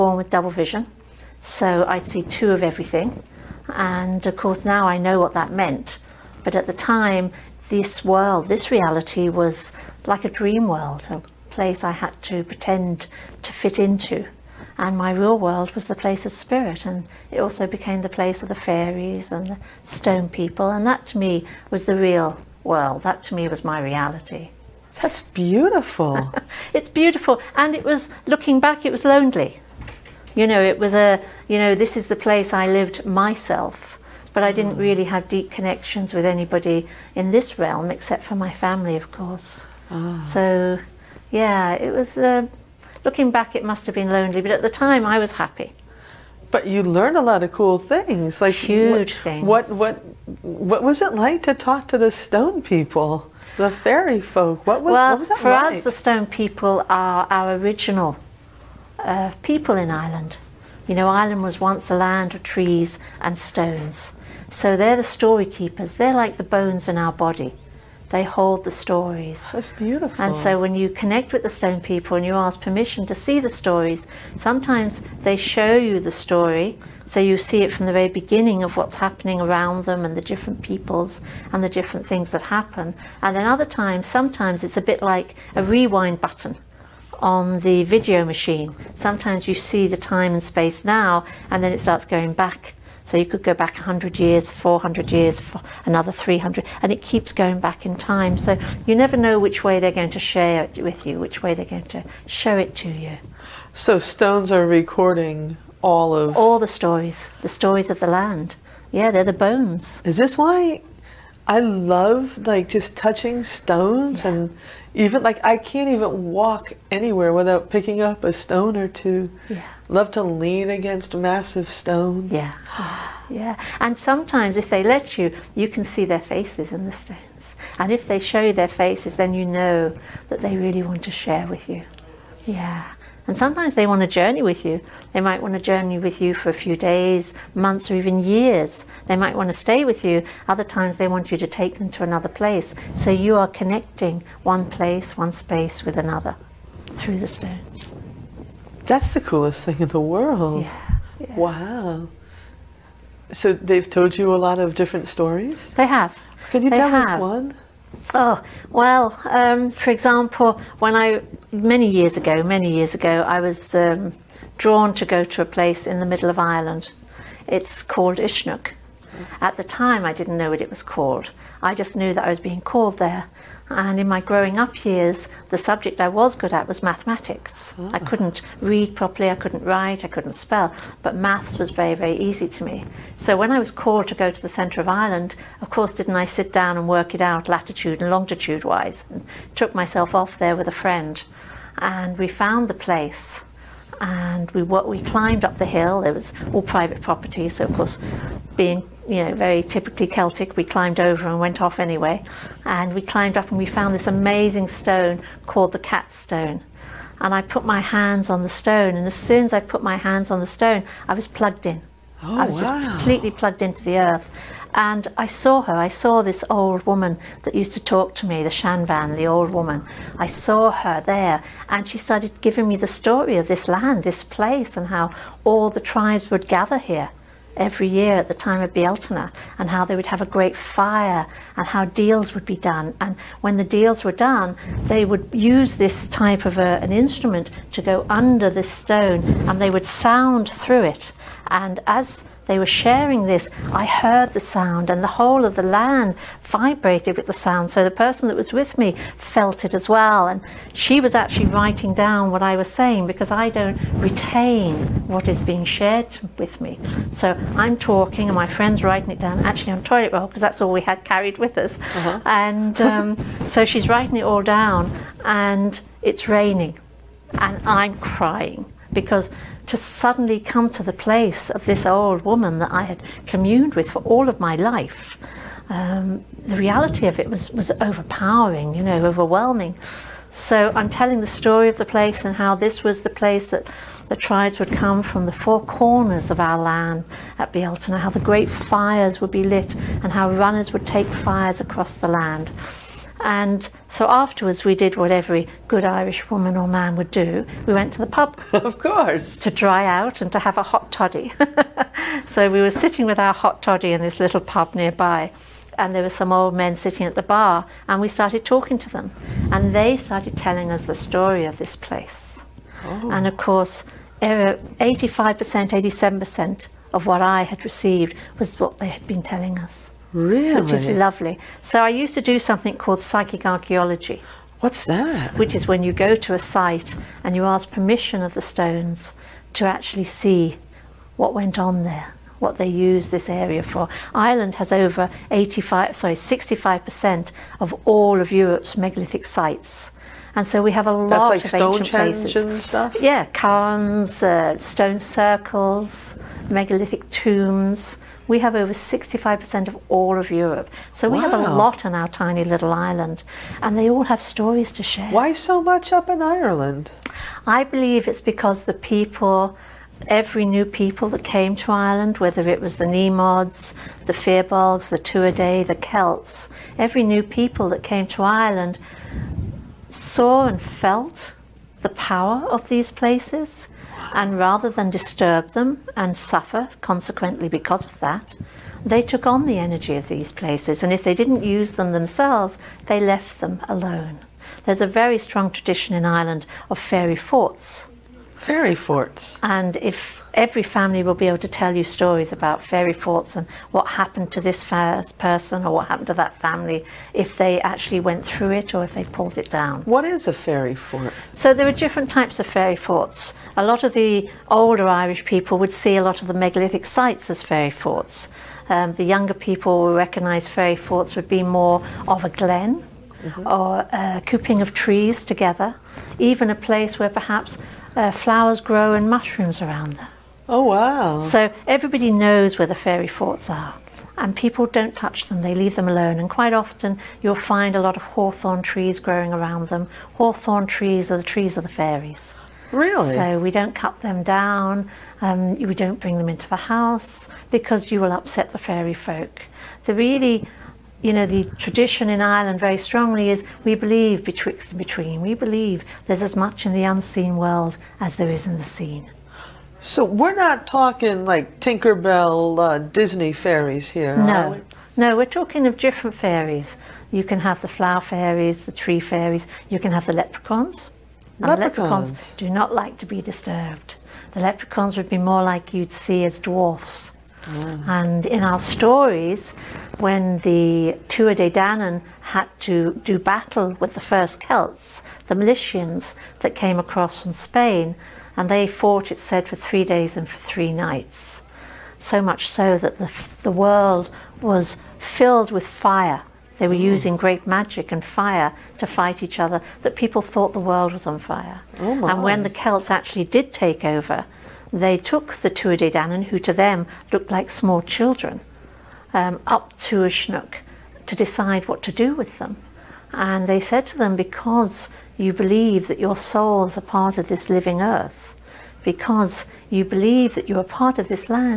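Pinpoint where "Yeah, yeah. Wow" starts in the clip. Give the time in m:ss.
2:30.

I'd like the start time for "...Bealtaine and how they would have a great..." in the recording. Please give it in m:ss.
3:48.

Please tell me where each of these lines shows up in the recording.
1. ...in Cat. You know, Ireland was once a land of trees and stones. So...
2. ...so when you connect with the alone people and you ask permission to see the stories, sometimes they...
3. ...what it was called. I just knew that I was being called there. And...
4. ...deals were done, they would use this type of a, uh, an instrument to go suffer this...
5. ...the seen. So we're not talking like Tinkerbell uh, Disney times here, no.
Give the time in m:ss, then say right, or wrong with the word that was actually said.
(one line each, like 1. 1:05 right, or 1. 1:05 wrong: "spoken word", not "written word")
1. 0:59 wrong: "Ireland", not "Cat"
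2. 1:10 wrong: "stone", not "alone"
3. 2:50 right
4. 3:53 wrong: "under", not "suffer"
5. 7:28 wrong: "fairies", not "times".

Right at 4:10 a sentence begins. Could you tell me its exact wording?
And she was actually writing down what I was saying because I don't retain what is being shared with me.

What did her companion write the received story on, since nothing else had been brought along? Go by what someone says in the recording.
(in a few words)
Toilet roll.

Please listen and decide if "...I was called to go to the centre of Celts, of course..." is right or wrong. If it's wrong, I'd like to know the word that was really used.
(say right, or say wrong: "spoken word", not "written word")
wrong: "Ireland", not "Celts".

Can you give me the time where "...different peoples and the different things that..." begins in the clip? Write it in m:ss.
1:20.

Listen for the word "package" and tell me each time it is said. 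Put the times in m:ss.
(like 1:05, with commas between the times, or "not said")
not said.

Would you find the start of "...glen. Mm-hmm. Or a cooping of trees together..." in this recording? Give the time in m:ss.
6:52.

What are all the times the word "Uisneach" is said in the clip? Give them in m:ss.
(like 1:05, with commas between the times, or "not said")
2:48, 8:19.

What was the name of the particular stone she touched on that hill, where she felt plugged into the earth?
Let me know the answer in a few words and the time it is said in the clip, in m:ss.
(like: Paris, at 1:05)
The Cat's Stone, at 3:25.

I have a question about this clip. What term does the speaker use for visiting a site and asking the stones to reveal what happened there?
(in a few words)
Psychic archaeology.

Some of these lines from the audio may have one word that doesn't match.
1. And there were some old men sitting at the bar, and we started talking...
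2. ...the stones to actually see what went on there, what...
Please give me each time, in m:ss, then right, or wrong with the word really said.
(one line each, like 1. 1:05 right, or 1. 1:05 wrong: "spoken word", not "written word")
1. 5:05 right
2. 5:28 right.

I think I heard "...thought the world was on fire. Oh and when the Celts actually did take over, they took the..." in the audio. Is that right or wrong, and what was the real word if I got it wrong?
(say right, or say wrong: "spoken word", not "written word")
right.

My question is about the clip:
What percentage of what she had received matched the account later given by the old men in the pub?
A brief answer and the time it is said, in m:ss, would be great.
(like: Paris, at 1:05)
87%, at 5:15.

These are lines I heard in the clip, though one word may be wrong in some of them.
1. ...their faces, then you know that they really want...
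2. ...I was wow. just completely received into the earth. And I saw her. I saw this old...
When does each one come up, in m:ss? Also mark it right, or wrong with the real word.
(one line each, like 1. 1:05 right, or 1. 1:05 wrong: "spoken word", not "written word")
1. 2:08 right
2. 3:32 wrong: "plugged", not "received".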